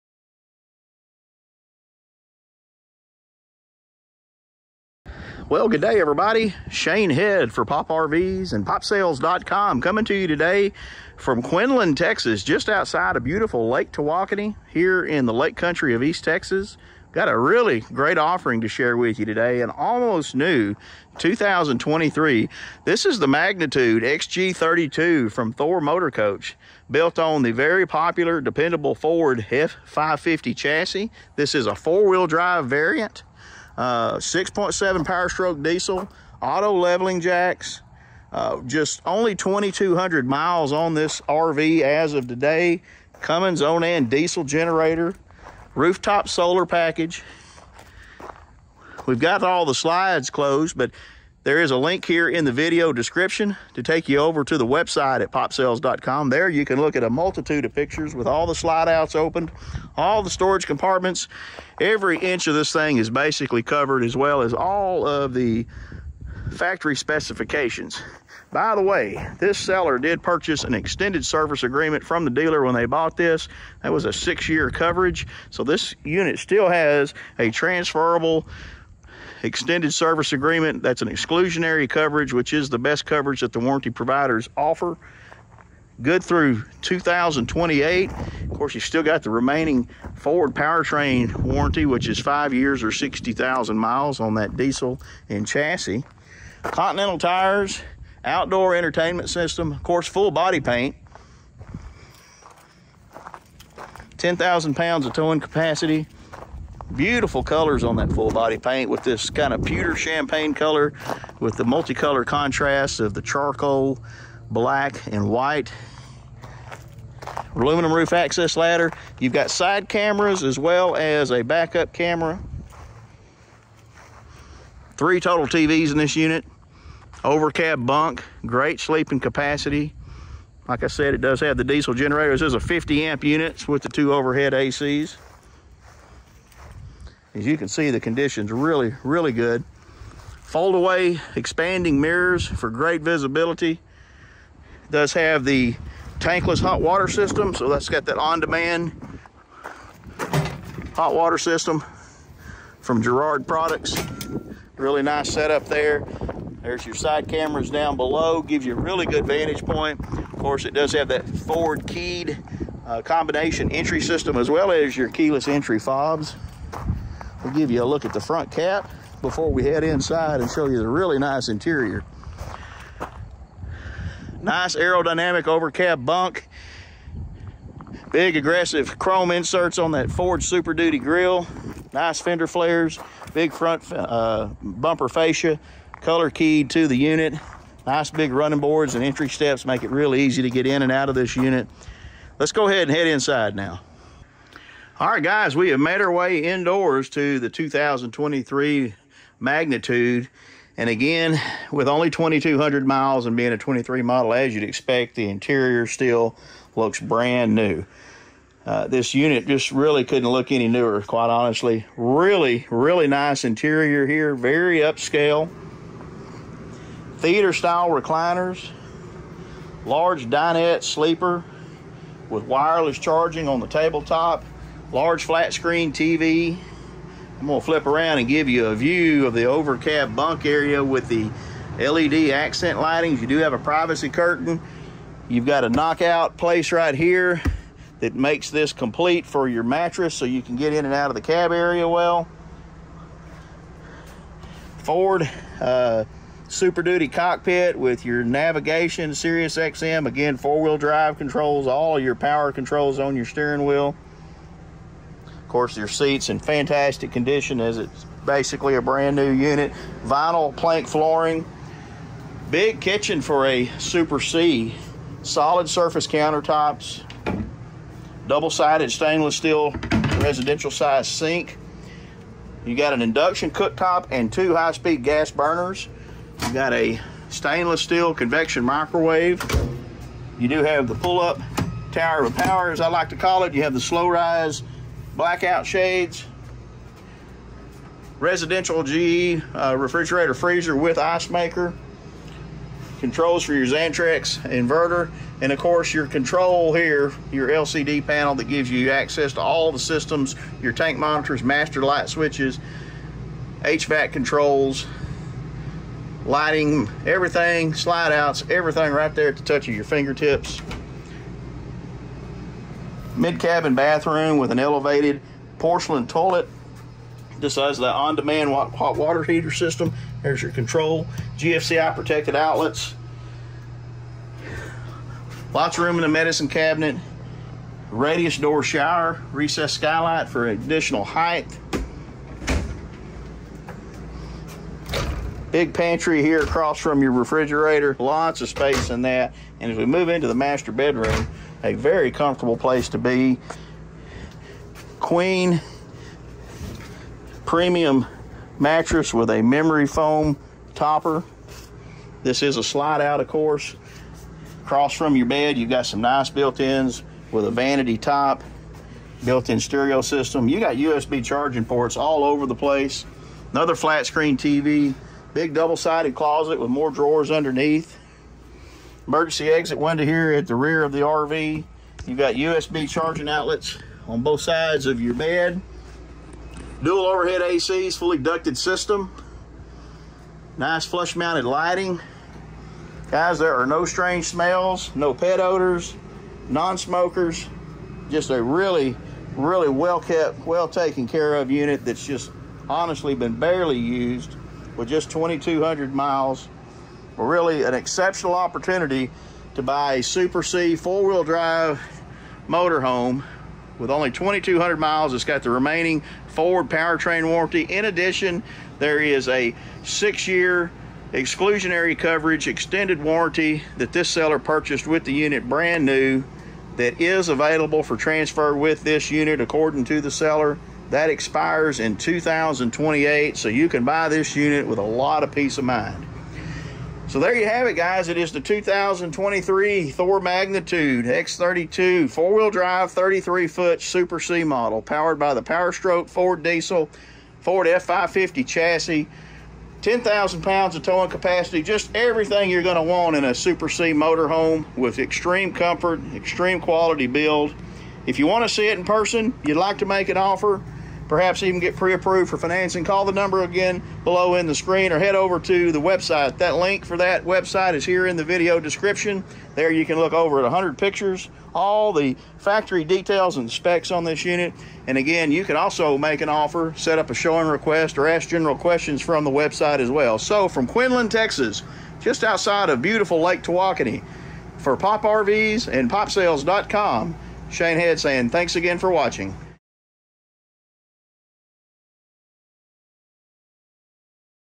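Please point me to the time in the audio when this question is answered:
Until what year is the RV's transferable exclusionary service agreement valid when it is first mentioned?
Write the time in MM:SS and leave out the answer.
01:26.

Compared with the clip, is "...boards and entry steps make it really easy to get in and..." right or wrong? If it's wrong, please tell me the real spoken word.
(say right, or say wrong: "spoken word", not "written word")
right.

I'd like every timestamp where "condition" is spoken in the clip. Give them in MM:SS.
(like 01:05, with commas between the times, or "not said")
02:17, 04:17.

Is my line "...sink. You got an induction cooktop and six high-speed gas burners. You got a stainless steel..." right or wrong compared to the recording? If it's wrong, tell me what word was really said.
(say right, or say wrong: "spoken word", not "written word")
wrong: "two", not "six".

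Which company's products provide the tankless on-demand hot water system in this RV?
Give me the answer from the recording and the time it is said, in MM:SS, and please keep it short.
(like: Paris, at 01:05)
Girard Products, at 02:33.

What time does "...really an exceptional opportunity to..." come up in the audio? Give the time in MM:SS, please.
06:37.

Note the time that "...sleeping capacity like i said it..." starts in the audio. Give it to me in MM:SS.
02:08.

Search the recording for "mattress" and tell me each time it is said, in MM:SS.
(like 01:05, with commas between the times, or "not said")
03:59, 05:48.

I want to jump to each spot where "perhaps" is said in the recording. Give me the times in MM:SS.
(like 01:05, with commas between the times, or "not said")
07:31.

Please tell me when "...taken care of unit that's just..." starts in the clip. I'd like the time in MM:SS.
06:30.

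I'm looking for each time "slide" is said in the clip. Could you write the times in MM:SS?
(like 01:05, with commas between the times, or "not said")
00:49, 00:58, 05:07, 05:52.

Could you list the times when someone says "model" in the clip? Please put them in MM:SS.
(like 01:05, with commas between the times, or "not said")
03:24, 07:14.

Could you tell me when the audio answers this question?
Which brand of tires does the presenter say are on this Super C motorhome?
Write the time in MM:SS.
01:36.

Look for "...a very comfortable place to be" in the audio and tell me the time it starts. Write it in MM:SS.
05:41.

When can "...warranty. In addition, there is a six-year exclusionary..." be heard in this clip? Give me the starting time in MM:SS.
06:47.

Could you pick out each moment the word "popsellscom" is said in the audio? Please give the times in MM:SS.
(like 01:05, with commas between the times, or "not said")
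00:08, 00:55, 07:55.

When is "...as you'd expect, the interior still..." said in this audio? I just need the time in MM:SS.
03:24.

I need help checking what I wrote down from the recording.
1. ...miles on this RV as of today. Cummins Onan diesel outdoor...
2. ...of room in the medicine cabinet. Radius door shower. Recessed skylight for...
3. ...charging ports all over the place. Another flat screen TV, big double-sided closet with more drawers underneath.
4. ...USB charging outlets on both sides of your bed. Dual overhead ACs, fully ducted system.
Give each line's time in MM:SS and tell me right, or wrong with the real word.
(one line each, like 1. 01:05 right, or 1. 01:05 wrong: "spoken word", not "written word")
1. 00:40 wrong: "generator", not "outdoor"
2. 05:25 right
3. 06:01 right
4. 06:12 right.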